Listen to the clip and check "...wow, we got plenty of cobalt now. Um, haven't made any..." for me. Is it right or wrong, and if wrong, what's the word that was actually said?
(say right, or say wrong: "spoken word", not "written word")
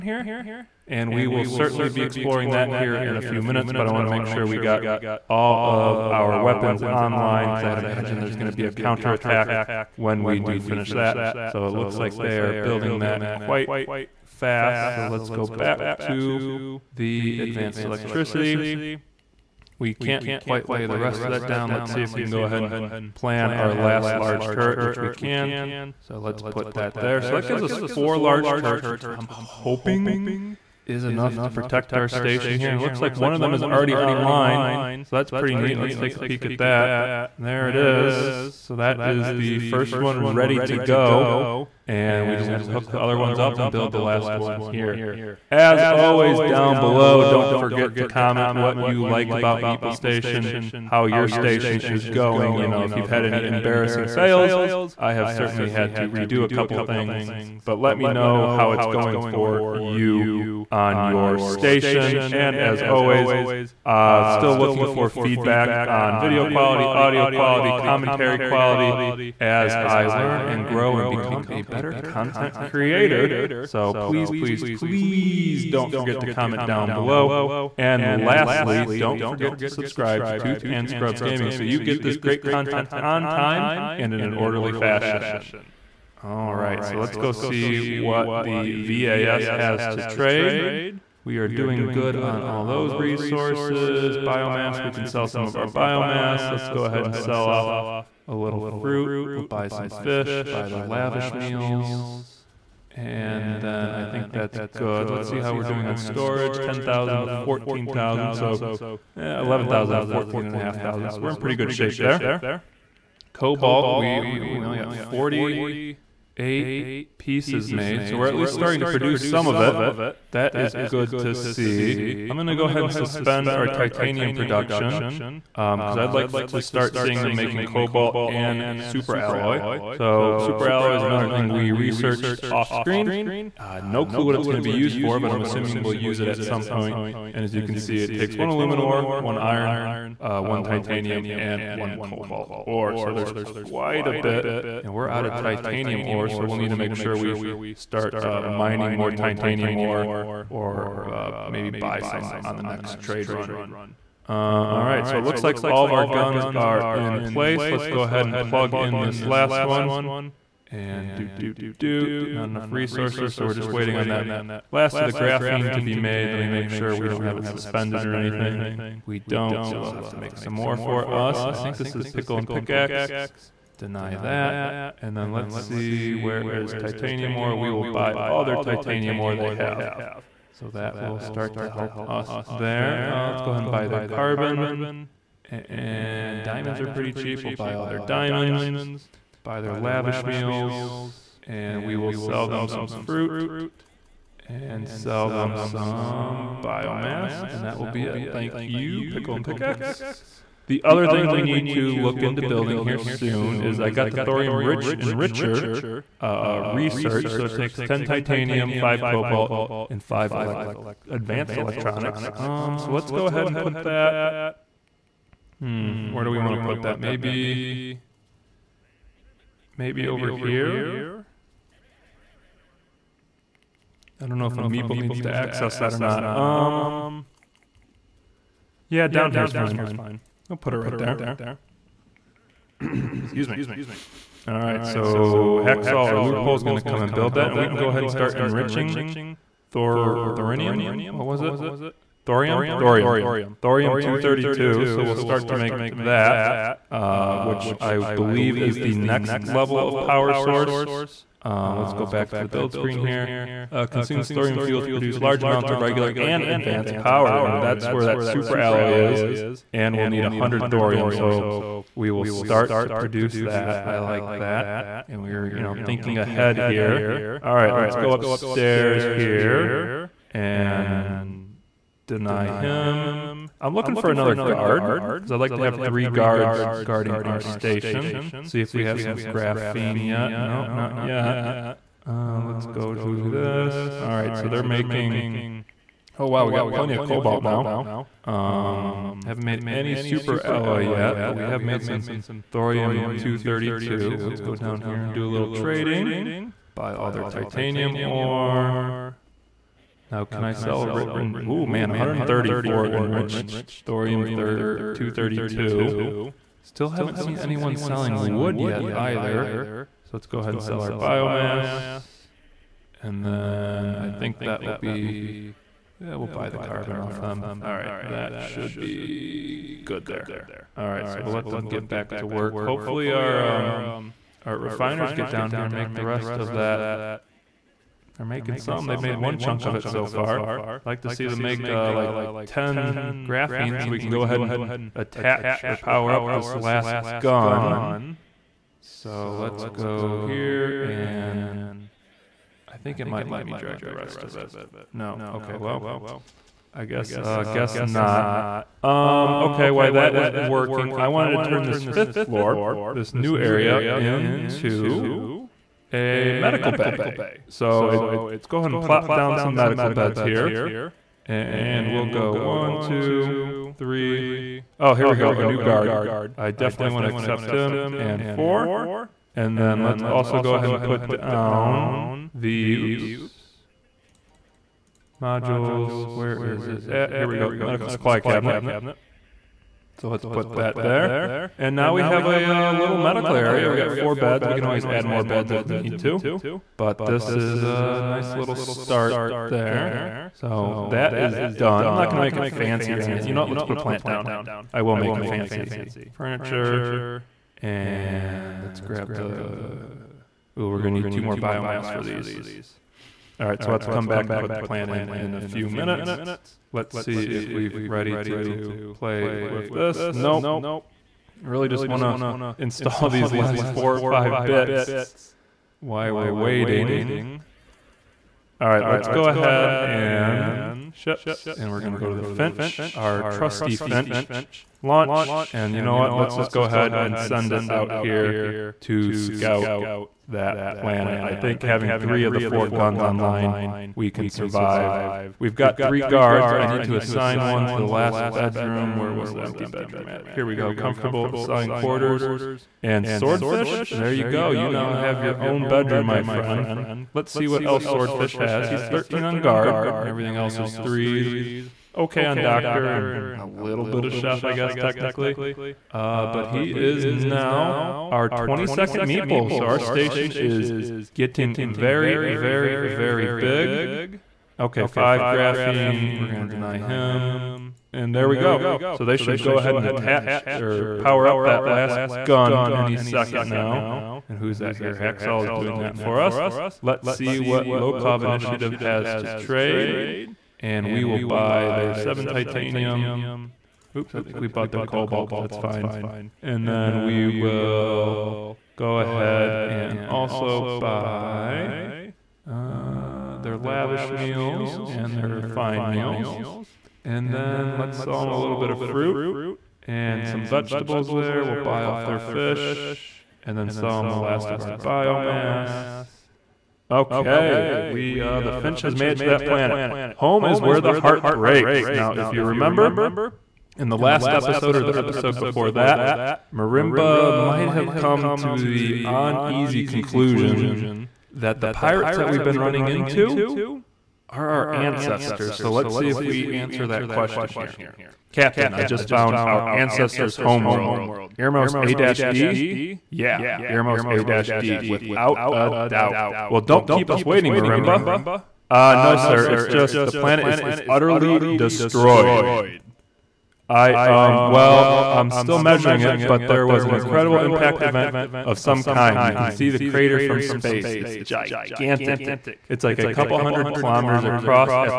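right.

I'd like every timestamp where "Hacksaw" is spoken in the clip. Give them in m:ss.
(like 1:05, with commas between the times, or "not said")
3:55, 7:54.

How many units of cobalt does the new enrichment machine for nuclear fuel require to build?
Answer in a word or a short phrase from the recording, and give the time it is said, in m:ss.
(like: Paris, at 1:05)
5, at 3:28.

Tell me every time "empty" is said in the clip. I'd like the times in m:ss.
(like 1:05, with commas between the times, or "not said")
7:19.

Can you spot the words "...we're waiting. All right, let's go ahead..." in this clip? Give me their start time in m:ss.
6:56.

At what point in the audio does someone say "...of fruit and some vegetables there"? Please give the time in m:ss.
8:18.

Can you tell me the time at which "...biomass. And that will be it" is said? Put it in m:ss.
3:16.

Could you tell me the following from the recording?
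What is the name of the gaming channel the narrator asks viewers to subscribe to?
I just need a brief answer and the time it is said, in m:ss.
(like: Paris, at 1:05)
Tooth and Scrubs Gaming, at 1:20.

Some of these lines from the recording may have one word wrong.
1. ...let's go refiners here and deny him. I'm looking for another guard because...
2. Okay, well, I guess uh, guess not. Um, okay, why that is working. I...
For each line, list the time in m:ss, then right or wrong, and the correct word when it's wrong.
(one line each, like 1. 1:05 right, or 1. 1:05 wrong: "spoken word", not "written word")
1. 4:27 wrong: "upstairs", not "refiners"
2. 5:45 right.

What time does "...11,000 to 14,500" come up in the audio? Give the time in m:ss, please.
1:49.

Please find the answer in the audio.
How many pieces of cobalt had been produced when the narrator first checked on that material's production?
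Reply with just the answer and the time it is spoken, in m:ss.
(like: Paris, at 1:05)
48, at 1:54.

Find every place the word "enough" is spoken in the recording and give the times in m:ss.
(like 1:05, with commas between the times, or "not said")
0:31, 2:42.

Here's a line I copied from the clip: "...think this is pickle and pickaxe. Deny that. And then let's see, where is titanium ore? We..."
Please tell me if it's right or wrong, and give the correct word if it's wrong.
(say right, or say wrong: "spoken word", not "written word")
right.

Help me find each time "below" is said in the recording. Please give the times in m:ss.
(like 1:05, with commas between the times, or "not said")
0:46, 1:16.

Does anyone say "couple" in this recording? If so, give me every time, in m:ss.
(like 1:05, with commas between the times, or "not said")
0:56, 9:13.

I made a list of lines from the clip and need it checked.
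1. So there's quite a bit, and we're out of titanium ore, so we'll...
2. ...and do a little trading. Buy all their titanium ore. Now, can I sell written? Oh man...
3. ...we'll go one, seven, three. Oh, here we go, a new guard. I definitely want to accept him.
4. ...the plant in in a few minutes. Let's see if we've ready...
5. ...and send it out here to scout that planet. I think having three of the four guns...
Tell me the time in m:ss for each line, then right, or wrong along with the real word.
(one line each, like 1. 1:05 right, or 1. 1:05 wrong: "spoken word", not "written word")
1. 2:22 right
2. 4:55 right
3. 6:01 wrong: "two", not "seven"
4. 6:44 right
5. 7:06 right.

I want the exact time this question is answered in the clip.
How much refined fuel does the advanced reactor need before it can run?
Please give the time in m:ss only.
4:20.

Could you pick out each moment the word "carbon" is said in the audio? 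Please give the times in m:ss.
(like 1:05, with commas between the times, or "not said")
3:04, 5:16.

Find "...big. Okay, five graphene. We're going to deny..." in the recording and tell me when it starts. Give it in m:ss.
7:43.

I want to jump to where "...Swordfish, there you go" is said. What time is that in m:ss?
7:23.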